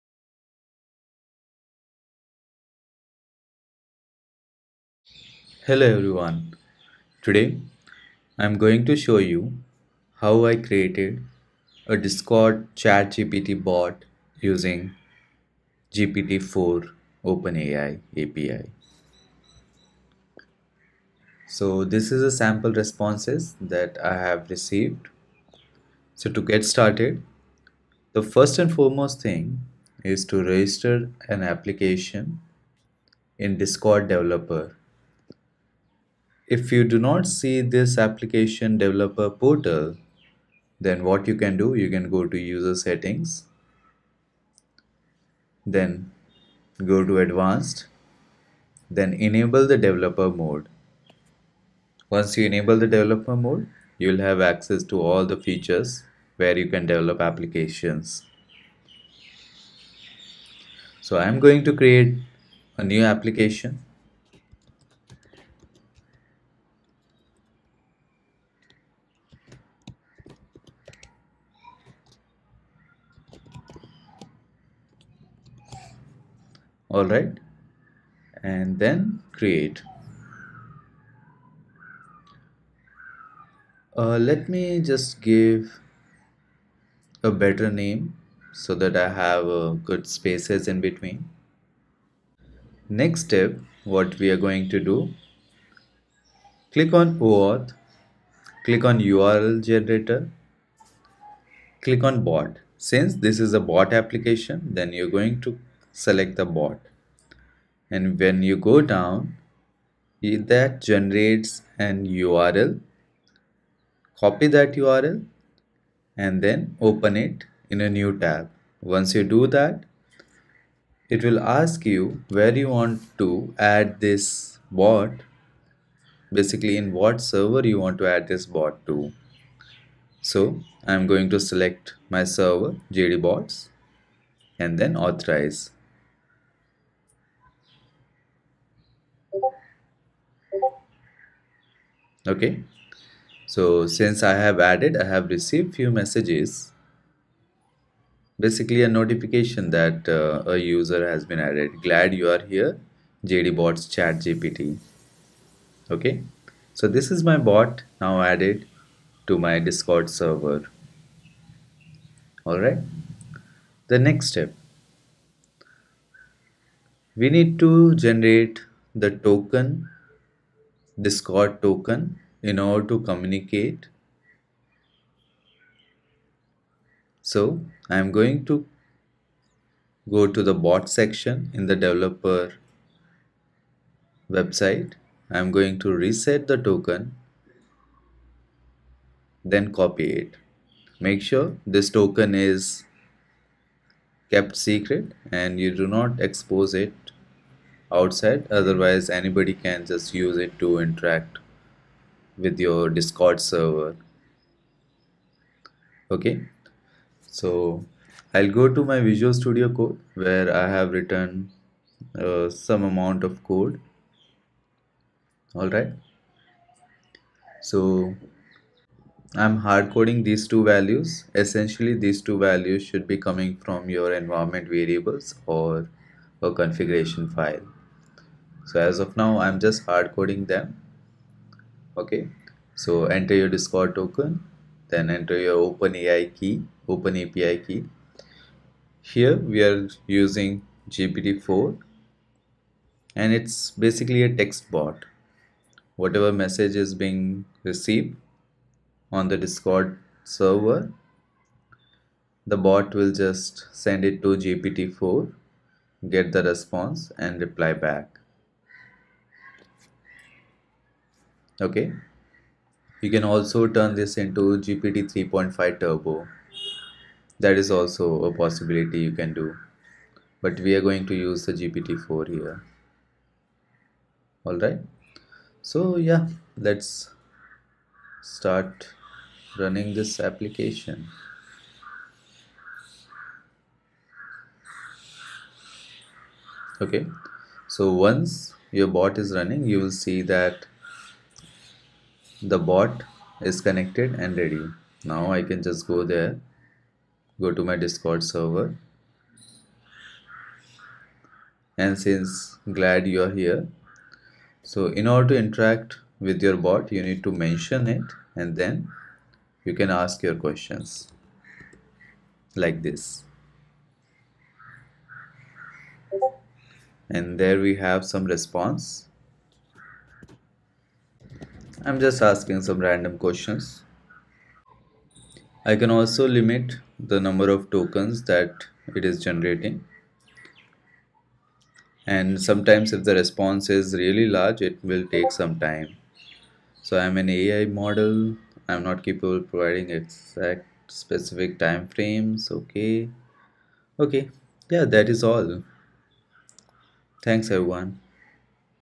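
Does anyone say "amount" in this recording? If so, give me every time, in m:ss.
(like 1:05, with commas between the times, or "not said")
3:32.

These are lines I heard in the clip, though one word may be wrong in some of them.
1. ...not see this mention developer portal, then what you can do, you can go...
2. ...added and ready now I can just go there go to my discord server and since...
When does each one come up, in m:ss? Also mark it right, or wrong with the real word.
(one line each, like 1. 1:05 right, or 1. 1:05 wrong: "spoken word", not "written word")
1. 0:36 wrong: "application", not "mention"
2. 4:53 wrong: "connected", not "added".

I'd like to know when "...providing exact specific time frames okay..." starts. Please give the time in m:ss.
5:39.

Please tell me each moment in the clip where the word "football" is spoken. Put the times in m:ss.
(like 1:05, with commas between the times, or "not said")
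not said.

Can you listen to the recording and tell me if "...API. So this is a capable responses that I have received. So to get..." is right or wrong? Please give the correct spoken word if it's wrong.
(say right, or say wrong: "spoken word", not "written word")
wrong: "sample", not "capable".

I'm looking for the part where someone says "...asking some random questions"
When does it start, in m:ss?
5:22.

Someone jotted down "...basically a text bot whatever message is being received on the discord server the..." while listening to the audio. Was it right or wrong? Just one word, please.
right.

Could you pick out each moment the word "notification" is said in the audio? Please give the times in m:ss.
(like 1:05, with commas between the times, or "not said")
2:28.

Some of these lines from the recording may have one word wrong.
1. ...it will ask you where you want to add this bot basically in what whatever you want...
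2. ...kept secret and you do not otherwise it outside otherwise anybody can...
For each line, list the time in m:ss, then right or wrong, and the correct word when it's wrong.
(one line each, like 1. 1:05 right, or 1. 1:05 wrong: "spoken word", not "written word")
1. 2:01 wrong: "server", not "whatever"
2. 3:14 wrong: "expose", not "otherwise".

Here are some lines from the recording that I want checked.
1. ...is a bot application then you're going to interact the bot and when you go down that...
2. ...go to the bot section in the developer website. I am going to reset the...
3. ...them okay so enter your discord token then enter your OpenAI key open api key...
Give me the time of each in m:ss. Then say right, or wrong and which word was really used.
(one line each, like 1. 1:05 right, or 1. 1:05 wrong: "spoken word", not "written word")
1. 1:43 wrong: "select", not "interact"
2. 3:00 right
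3. 3:50 right.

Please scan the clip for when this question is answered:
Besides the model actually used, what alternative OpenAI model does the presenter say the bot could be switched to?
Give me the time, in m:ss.
4:24.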